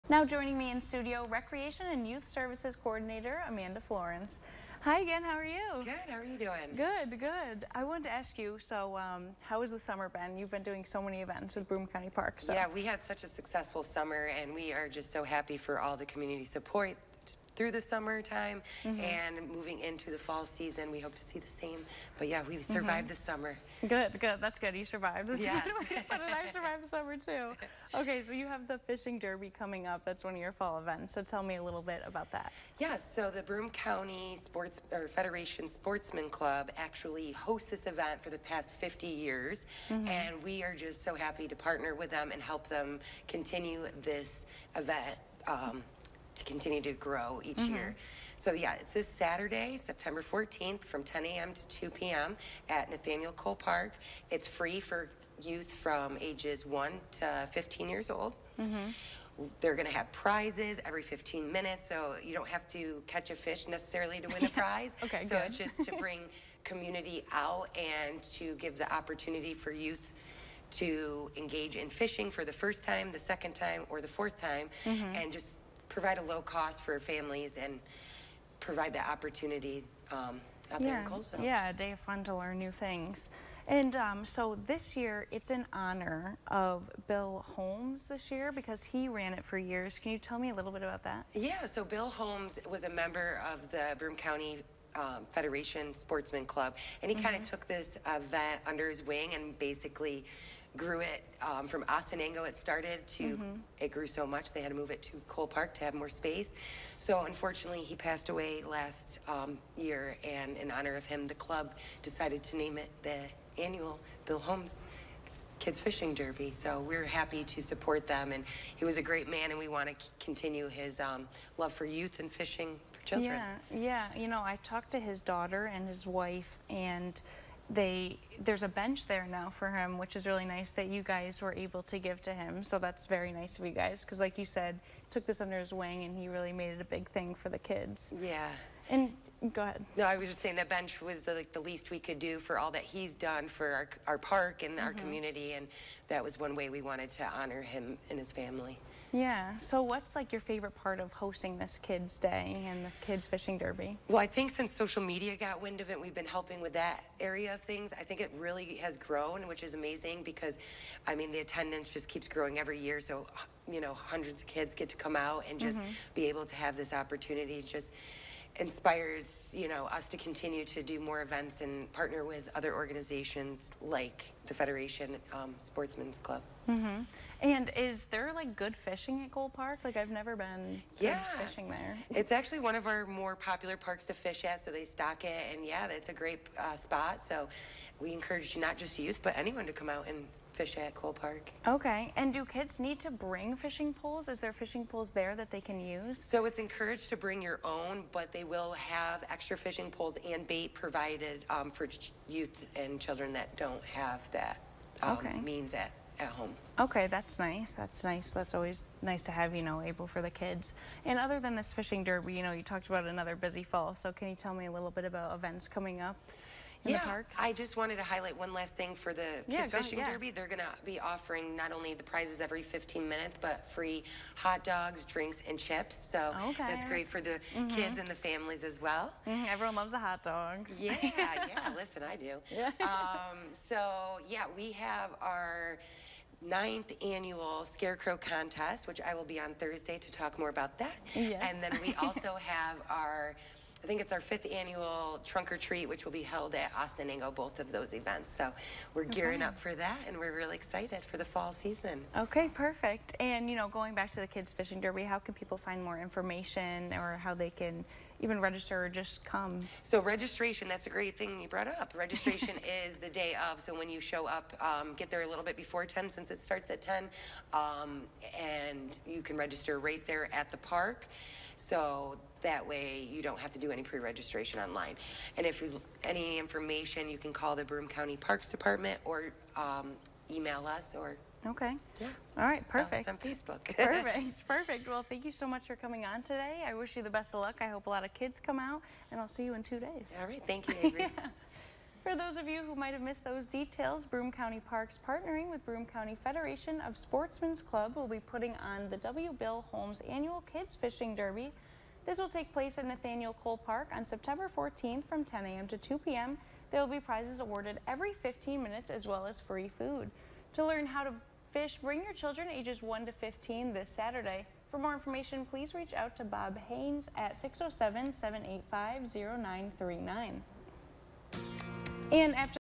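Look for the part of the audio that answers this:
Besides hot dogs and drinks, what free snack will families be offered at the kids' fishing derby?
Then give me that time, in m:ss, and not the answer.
3:45.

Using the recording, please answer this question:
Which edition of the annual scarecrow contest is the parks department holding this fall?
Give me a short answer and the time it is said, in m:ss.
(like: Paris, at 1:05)
Ninth, at 3:56.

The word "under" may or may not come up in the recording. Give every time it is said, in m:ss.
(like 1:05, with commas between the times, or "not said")
1:38, 2:15.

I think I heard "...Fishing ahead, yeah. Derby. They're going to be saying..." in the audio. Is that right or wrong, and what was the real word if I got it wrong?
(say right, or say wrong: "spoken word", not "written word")
wrong: "offering", not "saying".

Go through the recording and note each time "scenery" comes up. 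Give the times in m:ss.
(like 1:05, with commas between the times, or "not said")
not said.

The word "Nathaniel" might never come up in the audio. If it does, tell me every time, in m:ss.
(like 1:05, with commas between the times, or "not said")
0:52, 5:02.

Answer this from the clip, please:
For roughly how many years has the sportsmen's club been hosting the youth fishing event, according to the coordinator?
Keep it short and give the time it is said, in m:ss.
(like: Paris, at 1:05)
50 years, at 0:38.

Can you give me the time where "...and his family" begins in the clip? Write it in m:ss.
2:28.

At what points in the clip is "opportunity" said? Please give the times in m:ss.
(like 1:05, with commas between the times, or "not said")
1:08, 1:19, 2:46.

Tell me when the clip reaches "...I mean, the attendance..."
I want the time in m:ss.
2:41.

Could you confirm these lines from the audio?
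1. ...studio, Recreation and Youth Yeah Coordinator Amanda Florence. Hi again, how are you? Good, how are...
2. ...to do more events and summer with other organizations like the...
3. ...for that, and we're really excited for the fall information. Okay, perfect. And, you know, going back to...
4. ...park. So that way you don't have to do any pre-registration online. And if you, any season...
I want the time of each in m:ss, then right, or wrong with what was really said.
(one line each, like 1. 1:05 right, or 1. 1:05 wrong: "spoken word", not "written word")
1. 0:00 wrong: "Services", not "Yeah"
2. 2:50 wrong: "partner", not "summer"
3. 4:09 wrong: "season", not "information"
4. 4:30 wrong: "information", not "season".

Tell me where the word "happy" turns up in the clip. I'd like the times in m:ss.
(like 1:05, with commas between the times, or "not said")
0:15, 0:41, 1:57.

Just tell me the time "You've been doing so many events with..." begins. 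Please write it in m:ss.
0:10.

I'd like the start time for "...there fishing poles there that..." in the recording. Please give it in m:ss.
3:14.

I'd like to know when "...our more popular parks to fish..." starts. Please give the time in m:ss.
3:02.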